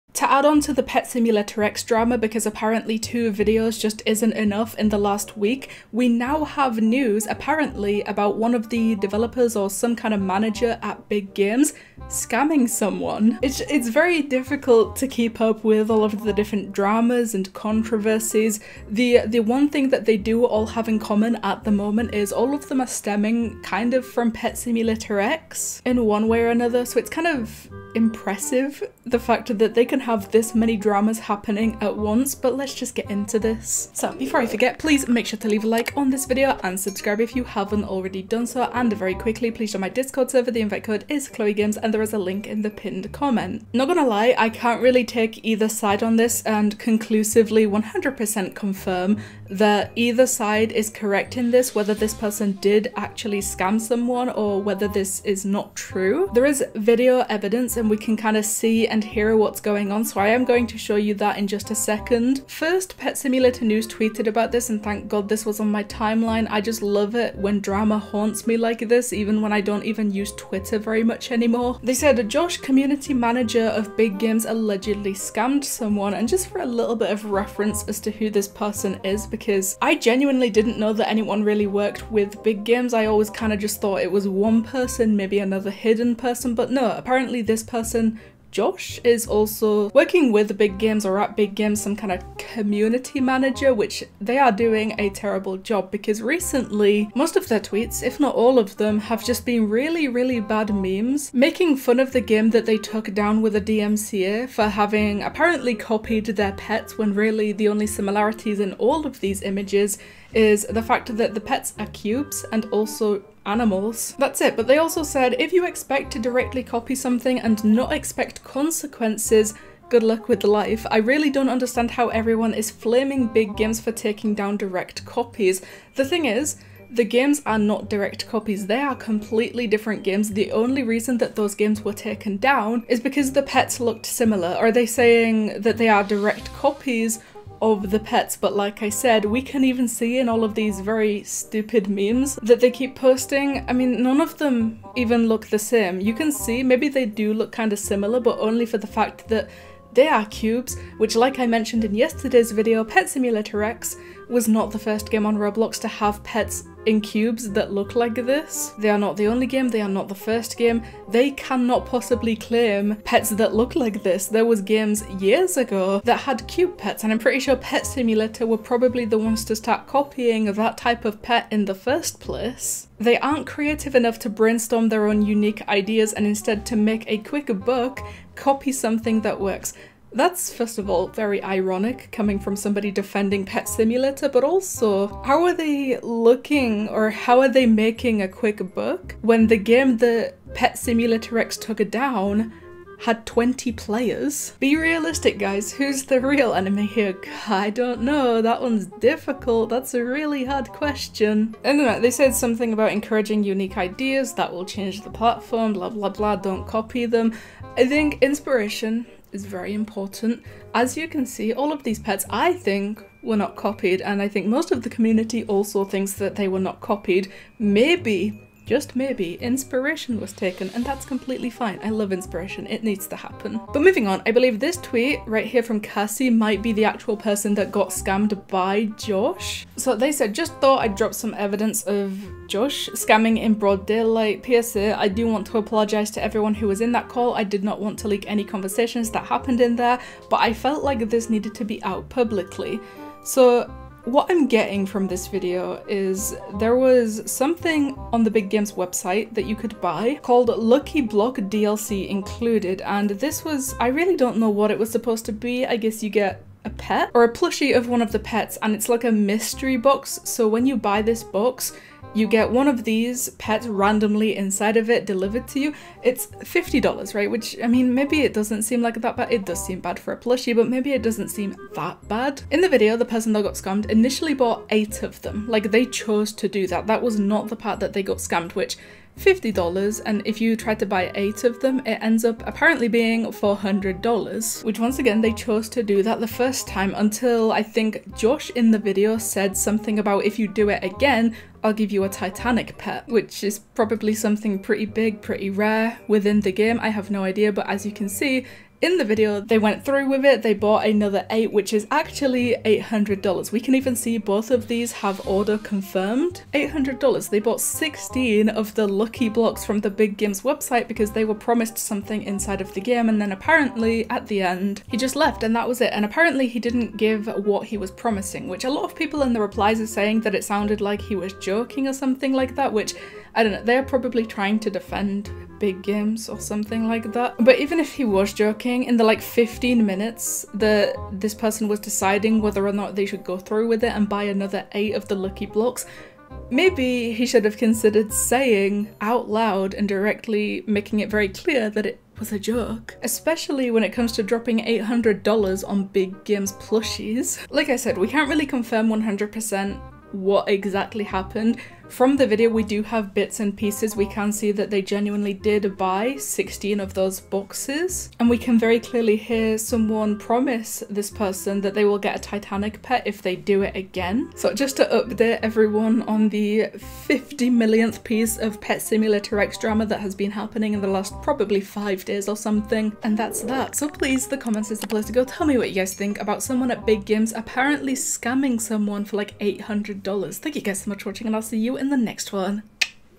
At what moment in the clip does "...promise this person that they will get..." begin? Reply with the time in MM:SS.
06:00.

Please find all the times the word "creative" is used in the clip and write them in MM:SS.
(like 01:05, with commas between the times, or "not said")
02:53.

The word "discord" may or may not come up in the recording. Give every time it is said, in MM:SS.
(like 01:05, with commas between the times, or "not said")
00:39.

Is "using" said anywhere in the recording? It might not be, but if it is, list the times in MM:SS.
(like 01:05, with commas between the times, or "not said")
not said.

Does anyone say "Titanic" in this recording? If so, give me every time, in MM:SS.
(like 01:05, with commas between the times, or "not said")
04:52, 06:02.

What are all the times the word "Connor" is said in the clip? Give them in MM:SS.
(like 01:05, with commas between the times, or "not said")
not said.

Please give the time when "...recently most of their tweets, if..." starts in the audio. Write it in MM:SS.
01:36.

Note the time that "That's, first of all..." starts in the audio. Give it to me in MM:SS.
03:00.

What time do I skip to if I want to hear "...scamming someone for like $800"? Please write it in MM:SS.
06:17.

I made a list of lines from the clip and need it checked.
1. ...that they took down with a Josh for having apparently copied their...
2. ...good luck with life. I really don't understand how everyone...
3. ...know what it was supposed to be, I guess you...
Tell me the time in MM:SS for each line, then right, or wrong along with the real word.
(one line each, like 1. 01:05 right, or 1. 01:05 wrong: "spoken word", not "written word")
1. 01:42 wrong: "DMCA", not "Josh"
2. 01:59 right
3. 04:14 right.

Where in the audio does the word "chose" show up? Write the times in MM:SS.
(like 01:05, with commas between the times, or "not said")
04:35, 04:45.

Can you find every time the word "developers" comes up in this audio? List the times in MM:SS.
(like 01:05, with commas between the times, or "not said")
00:08.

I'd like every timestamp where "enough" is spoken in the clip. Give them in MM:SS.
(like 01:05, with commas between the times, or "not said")
00:04, 02:53.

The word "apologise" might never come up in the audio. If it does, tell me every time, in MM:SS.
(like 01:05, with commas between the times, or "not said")
03:55.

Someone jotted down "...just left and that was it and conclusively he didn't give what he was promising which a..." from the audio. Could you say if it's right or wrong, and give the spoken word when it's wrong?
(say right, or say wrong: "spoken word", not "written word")
wrong: "apparently", not "conclusively".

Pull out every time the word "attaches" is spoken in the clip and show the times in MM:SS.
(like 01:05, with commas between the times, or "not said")
not said.